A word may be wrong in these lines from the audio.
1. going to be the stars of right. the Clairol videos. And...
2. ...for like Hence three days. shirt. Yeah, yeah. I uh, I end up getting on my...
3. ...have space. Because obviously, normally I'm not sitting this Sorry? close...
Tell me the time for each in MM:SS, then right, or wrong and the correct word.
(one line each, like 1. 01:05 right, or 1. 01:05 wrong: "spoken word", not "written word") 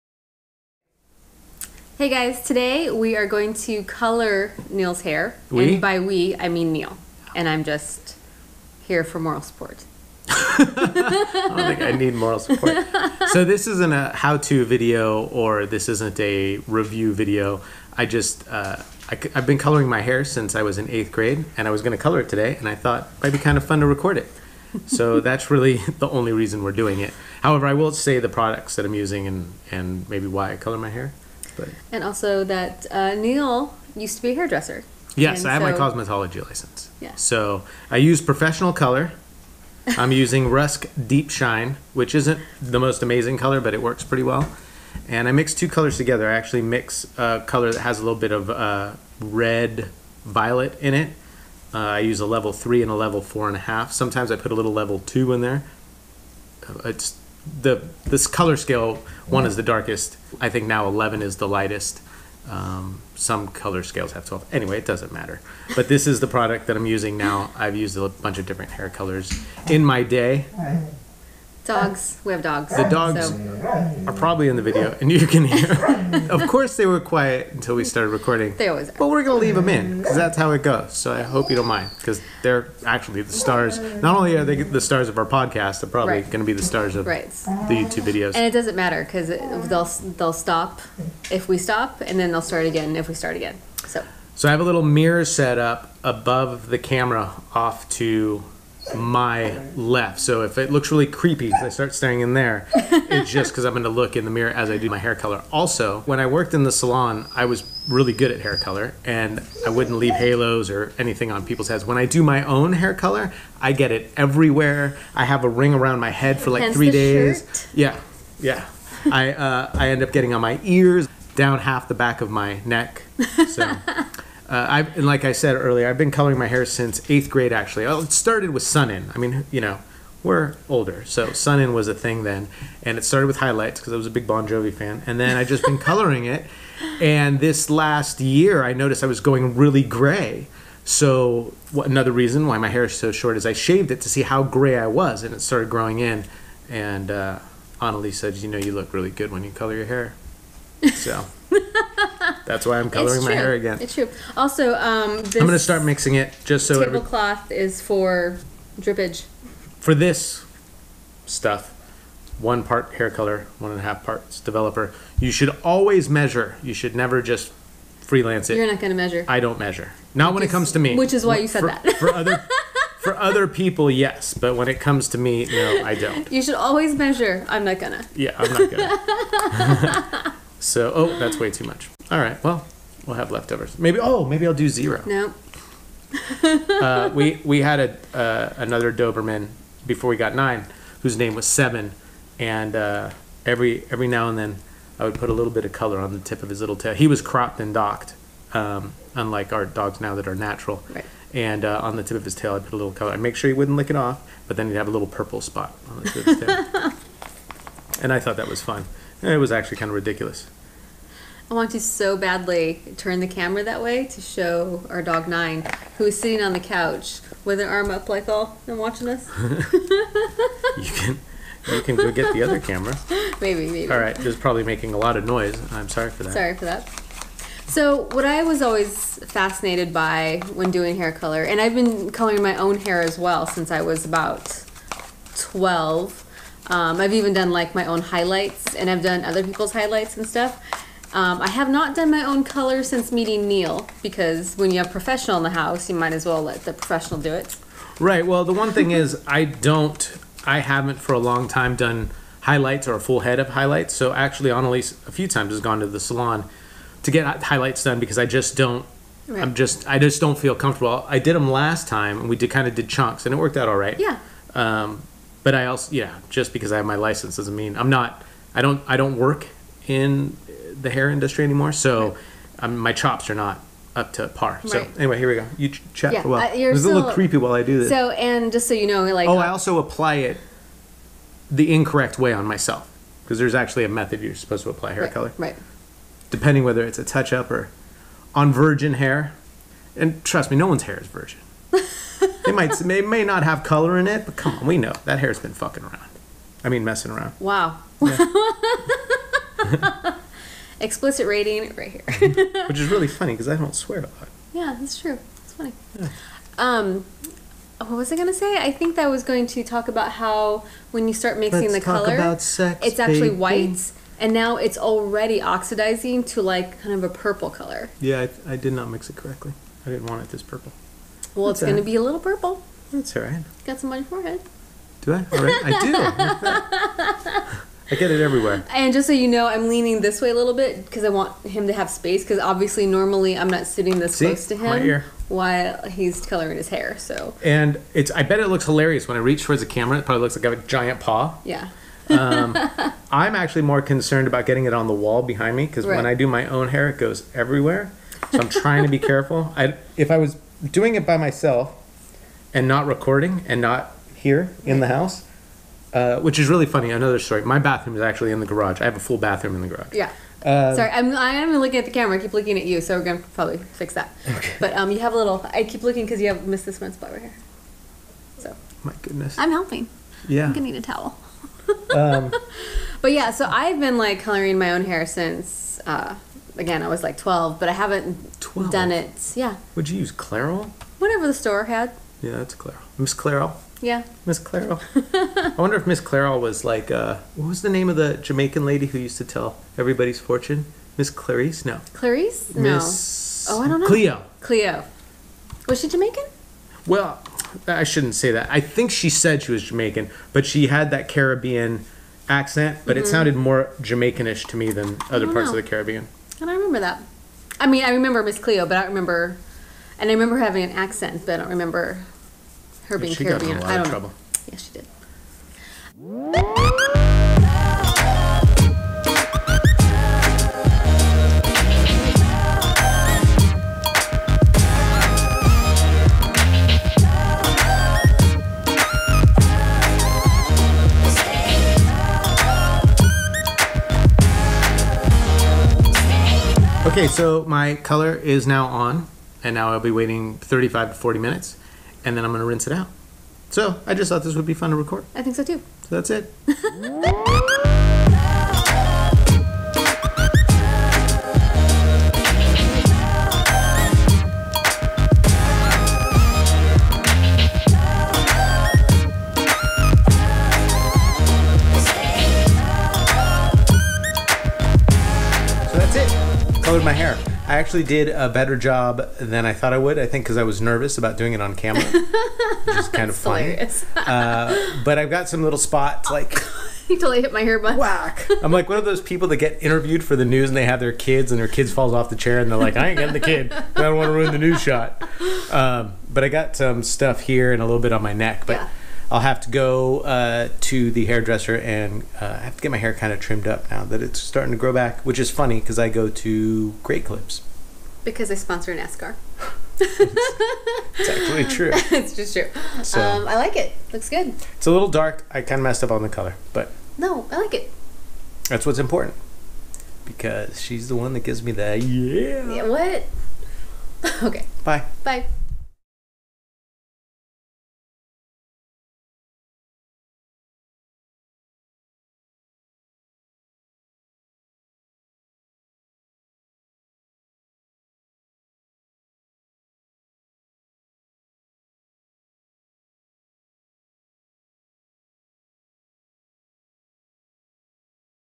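1. 01:26 wrong: "YouTube", not "Clairol"
2. 01:56 right
3. 05:31 wrong: "See", not "Sorry".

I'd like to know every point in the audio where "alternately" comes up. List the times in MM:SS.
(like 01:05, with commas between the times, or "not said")
not said.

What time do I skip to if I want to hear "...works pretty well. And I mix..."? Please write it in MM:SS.
00:43.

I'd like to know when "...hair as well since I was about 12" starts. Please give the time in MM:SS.
03:52.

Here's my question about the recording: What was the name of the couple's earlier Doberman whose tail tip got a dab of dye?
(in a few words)
Seven.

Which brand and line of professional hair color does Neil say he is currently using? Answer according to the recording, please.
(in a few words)
Rusk Deep Shine.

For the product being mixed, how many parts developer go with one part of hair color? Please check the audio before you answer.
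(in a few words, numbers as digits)
1.5.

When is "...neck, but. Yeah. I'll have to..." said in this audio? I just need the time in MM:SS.
08:08.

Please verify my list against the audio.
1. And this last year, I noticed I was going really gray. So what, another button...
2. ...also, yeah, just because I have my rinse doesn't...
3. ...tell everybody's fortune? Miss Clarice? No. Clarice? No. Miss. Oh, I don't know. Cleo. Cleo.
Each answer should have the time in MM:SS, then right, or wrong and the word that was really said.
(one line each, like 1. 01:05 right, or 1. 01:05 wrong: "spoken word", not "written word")
1. 02:16 wrong: "reason", not "button"
2. 04:25 wrong: "license", not "rinse"
3. 06:29 right.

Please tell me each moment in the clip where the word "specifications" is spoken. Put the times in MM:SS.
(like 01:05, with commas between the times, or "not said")
not said.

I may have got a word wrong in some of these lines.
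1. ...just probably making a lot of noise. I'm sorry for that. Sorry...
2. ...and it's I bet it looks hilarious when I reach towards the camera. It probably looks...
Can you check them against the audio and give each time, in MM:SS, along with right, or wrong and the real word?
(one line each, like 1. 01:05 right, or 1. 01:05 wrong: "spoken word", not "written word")
1. 03:44 right
2. 05:37 right.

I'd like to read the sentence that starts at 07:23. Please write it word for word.
So I just thought this would be fun to record.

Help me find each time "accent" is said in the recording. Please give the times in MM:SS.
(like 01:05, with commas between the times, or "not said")
06:42, 06:50.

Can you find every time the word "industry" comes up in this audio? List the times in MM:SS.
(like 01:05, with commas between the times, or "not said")
04:31.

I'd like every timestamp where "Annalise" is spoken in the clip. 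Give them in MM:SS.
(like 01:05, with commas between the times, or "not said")
02:27, 04:14.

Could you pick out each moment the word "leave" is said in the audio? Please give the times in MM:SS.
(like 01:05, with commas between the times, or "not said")
01:19, 01:49.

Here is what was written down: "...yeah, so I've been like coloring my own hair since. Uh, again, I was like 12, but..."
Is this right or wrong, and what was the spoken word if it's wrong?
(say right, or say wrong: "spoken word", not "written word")
right.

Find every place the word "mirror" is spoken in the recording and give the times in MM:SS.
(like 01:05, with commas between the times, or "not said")
01:34, 01:44.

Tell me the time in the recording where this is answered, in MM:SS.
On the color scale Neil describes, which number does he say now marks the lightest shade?
01:00.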